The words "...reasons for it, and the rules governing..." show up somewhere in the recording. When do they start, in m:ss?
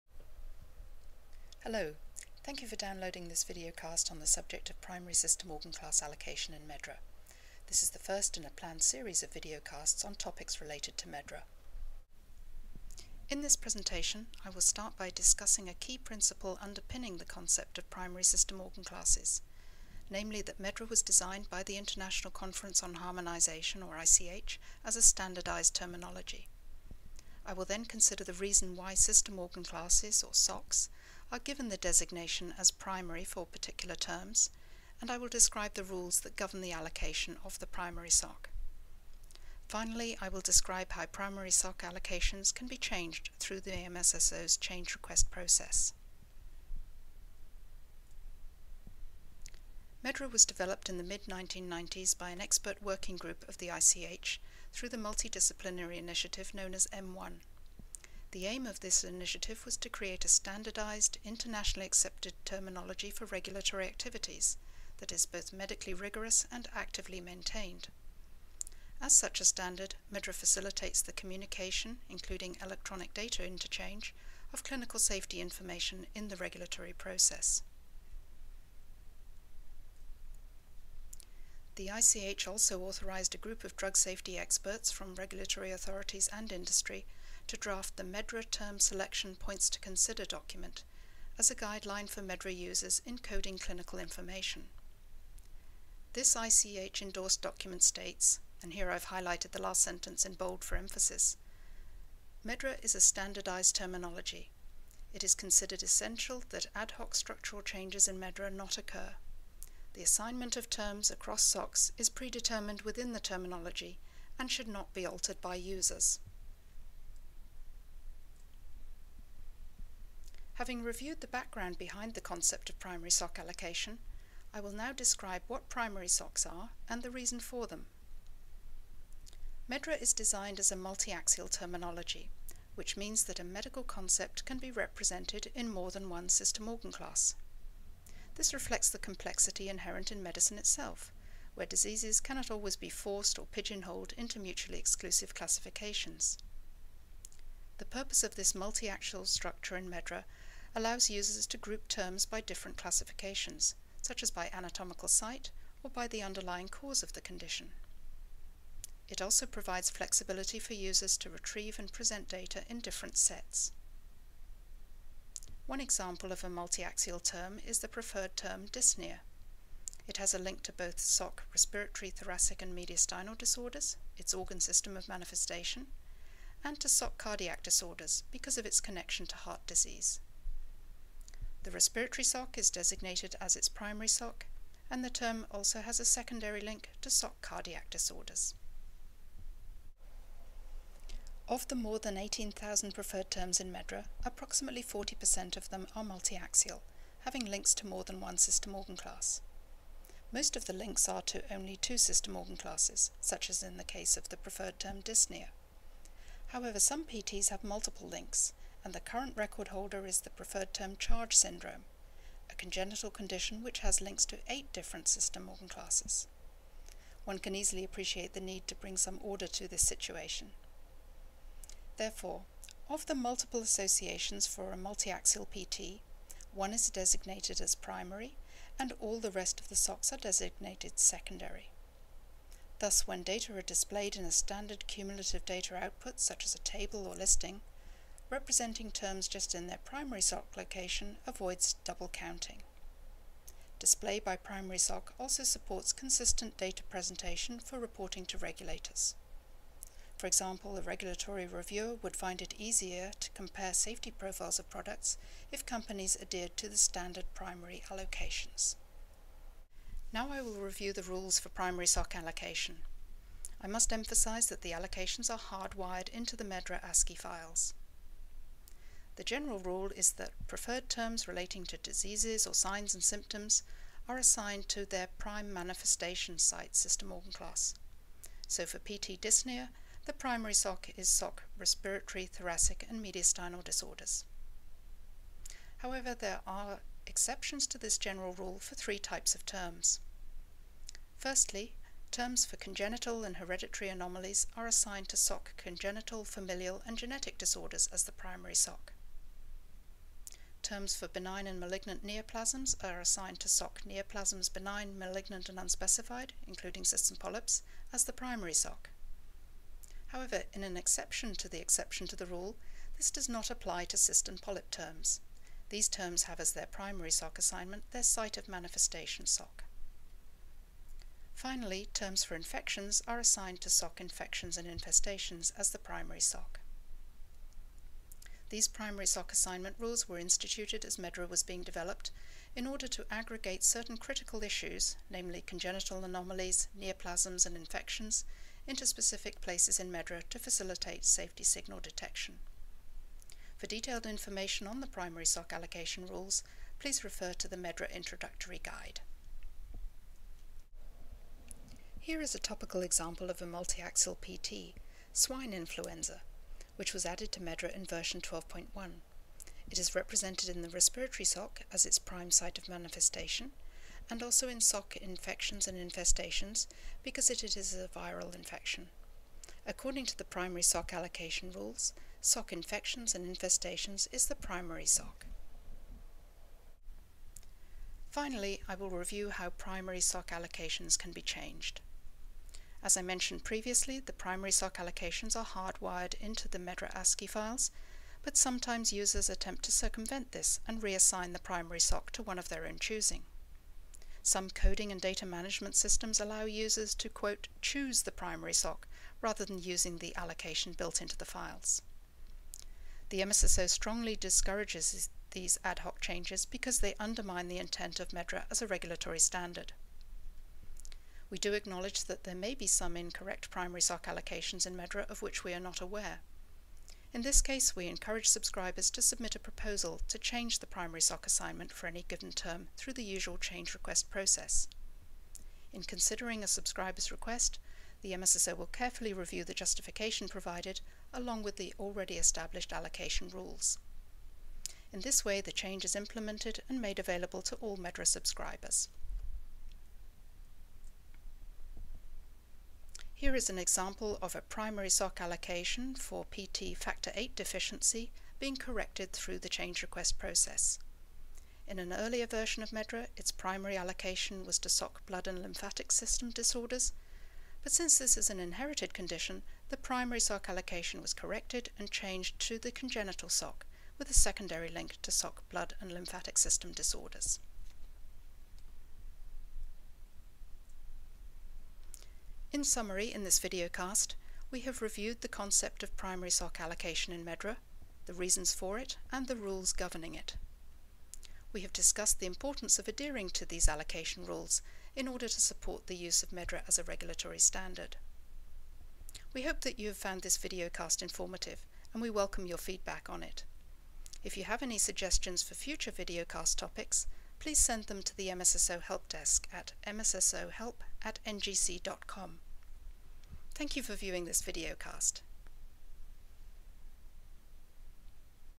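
7:58.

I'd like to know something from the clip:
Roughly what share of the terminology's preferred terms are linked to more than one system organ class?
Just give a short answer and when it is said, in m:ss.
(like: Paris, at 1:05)
40%, at 3:14.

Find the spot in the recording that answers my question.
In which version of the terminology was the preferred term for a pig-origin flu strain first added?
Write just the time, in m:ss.
5:57.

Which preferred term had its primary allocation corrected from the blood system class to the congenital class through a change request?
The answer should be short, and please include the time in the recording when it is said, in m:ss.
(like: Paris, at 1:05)
Factor 8 deficiency, at 7:26.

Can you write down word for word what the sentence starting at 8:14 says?
If you have any suggestions for future videocast topics, please send them to the MSSO Help Desk at mssohelp at ngc.com.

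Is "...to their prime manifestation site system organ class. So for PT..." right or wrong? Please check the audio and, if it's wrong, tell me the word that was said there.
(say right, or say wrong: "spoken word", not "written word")
right.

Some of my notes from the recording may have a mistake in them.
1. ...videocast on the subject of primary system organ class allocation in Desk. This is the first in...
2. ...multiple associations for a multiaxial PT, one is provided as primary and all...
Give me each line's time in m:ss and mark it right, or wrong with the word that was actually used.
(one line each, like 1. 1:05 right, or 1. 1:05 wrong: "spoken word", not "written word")
1. 0:03 wrong: "MedDRA", not "Desk"
2. 3:43 wrong: "designated", not "provided".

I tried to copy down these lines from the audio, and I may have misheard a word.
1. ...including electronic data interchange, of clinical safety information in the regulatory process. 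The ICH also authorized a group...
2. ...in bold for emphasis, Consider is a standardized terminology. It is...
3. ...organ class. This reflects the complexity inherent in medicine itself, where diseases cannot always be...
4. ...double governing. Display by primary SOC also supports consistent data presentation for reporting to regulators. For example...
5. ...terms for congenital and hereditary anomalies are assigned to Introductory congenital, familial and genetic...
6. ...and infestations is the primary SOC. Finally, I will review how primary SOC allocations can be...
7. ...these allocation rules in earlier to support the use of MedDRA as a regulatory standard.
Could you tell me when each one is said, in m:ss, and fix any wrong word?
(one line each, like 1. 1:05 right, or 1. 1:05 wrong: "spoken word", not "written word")
1. 1:12 right
2. 1:40 wrong: "MedDRA", not "Consider"
3. 2:16 right
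4. 4:01 wrong: "counting", not "governing"
5. 4:52 wrong: "SOC", not "Introductory"
6. 6:13 right
7. 8:03 wrong: "order", not "earlier".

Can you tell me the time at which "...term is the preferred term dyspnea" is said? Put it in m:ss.
2:47.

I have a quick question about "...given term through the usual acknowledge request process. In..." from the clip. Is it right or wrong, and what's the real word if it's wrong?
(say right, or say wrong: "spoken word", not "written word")
wrong: "change", not "acknowledge".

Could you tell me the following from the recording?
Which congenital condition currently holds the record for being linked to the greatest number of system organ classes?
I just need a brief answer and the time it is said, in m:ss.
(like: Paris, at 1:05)
CHARGE syndrome, at 3:30.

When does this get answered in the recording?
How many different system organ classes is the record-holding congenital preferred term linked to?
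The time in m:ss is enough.
3:34.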